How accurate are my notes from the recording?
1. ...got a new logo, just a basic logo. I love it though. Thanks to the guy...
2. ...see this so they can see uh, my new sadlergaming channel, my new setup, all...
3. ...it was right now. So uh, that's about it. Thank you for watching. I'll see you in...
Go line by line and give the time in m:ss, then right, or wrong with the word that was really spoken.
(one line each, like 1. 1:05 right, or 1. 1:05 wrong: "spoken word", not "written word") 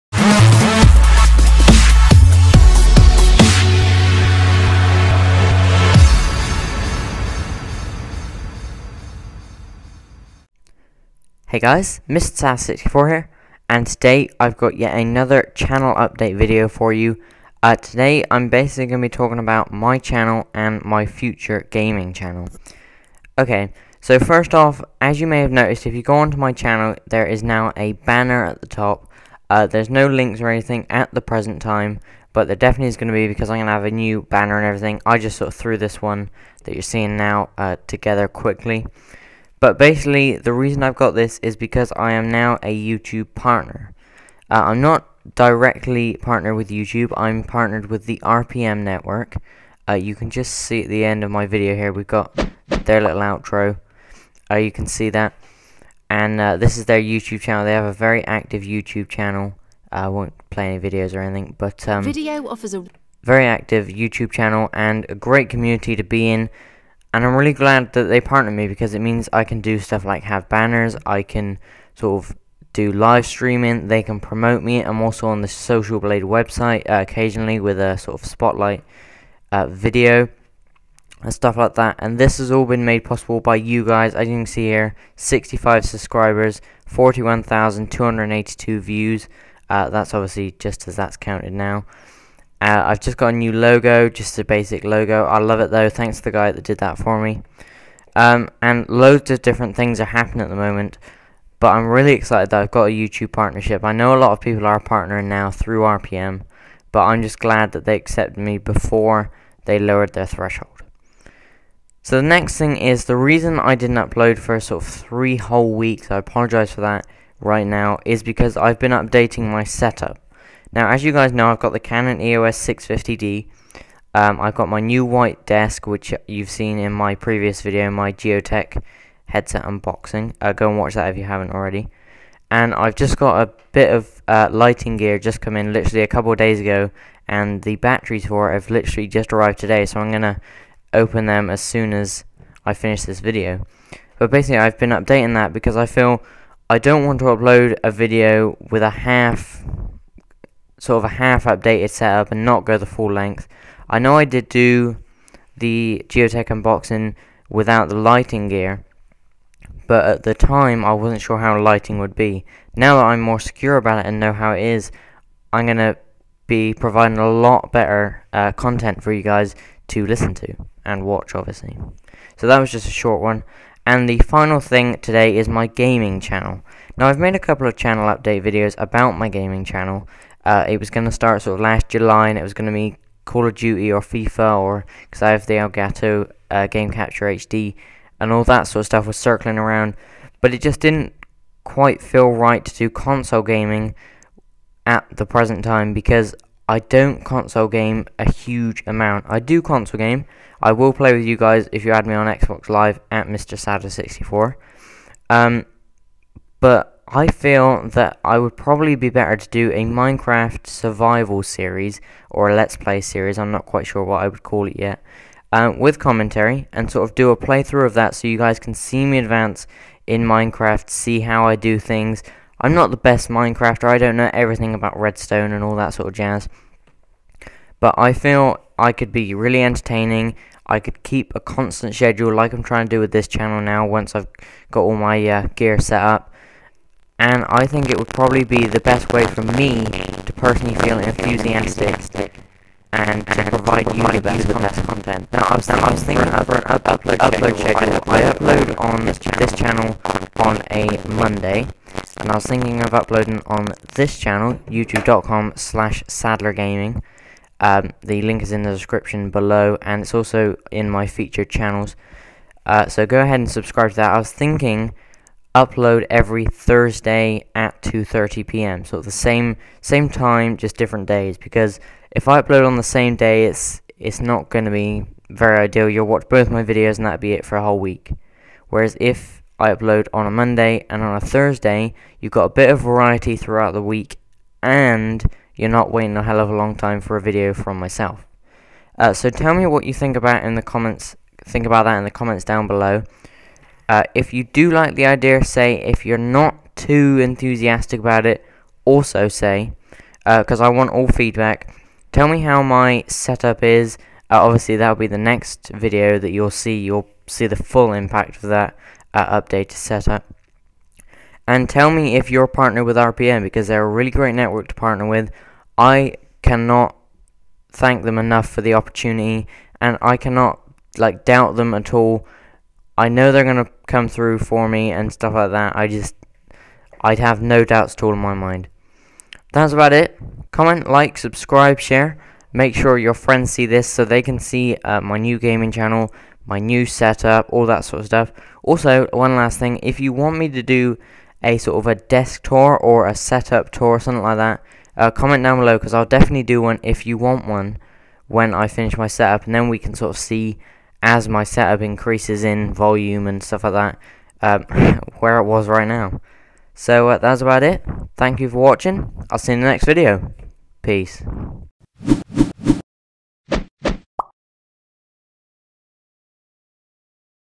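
1. 1:33 right
2. 5:33 wrong: "gaming", not "sadlergaming"
3. 5:55 right.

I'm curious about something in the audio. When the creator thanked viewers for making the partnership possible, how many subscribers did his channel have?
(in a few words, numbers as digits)
65.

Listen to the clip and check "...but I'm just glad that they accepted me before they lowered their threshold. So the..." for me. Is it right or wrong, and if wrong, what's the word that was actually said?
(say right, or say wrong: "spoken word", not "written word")
right.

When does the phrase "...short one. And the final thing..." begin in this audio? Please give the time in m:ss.
2:52.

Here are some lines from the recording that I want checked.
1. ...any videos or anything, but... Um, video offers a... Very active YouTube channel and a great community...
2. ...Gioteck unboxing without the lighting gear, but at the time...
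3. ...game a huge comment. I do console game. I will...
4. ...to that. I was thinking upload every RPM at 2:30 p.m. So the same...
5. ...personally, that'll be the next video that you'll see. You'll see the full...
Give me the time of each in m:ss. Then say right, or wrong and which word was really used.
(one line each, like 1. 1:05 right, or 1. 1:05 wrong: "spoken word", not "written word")
1. 1:00 right
2. 2:36 right
3. 3:17 wrong: "amount", not "comment"
4. 4:23 wrong: "Thursday", not "RPM"
5. 5:04 wrong: "obviously", not "personally".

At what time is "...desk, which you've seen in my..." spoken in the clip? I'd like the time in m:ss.
2:05.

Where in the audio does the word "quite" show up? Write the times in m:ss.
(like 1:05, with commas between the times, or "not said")
3:11, 3:33.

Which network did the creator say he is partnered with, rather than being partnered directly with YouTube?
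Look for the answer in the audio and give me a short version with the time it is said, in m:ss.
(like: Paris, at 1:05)
RPM network, at 0:48.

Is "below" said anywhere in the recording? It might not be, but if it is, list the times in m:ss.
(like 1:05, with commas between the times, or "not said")
4:19, 4:52, 5:45.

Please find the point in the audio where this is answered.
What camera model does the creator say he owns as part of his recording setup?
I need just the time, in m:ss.
2:01.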